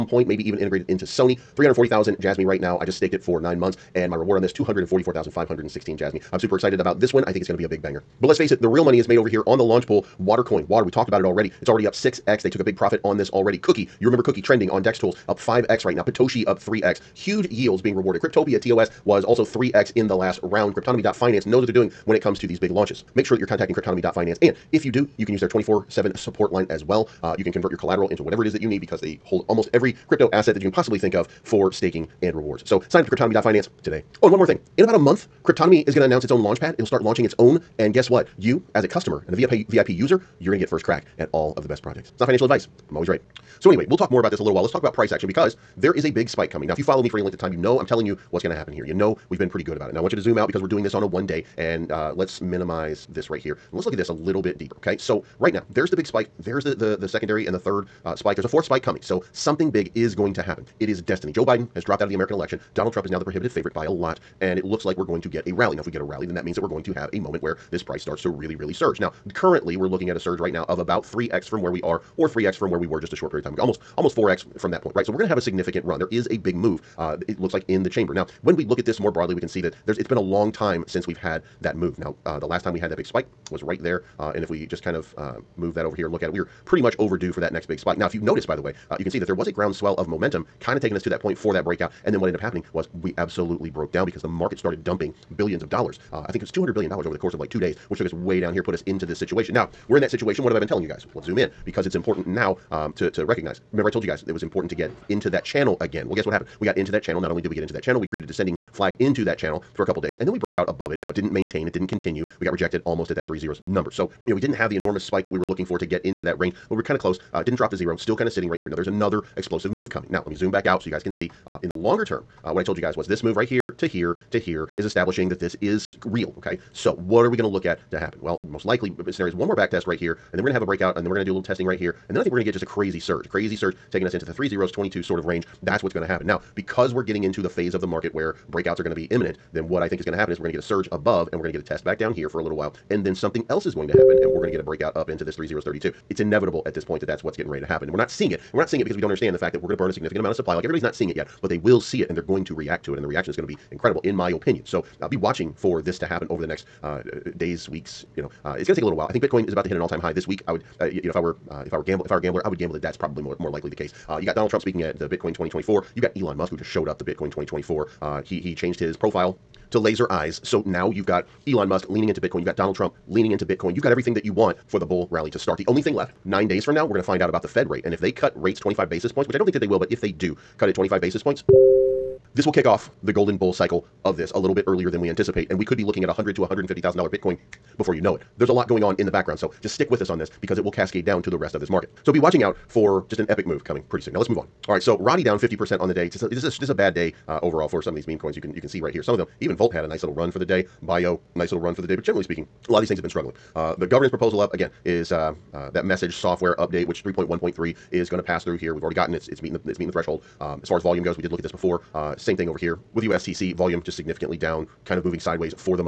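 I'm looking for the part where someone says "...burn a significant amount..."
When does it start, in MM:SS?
02:29.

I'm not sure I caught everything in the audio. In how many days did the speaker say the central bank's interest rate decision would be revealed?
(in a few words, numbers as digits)
nine days.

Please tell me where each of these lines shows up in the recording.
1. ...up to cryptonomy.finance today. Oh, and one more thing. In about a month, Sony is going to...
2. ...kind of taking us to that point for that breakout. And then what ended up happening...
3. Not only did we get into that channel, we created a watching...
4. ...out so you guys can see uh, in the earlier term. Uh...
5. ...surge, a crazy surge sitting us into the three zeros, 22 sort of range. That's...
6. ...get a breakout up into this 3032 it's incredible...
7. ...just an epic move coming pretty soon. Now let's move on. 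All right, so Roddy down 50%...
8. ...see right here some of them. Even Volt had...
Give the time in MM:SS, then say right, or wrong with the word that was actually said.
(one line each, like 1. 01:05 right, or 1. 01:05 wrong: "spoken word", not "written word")
1. 00:33 wrong: "Cryptonomy", not "Sony"
2. 01:30 right
3. 01:47 wrong: "descending", not "watching"
4. 02:00 wrong: "longer", not "earlier"
5. 02:12 wrong: "taking", not "sitting"
6. 02:24 wrong: "inevitable", not "incredible"
7. 03:13 right
8. 03:18 right.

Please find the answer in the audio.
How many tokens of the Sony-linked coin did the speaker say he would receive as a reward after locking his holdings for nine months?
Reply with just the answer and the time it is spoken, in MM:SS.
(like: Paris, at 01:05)
244,516, at 00:04.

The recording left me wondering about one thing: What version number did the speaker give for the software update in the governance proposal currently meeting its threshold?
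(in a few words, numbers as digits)
3.1.3.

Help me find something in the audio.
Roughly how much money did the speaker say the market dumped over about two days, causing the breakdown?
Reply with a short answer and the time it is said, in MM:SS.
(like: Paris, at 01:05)
$200 billion, at 01:36.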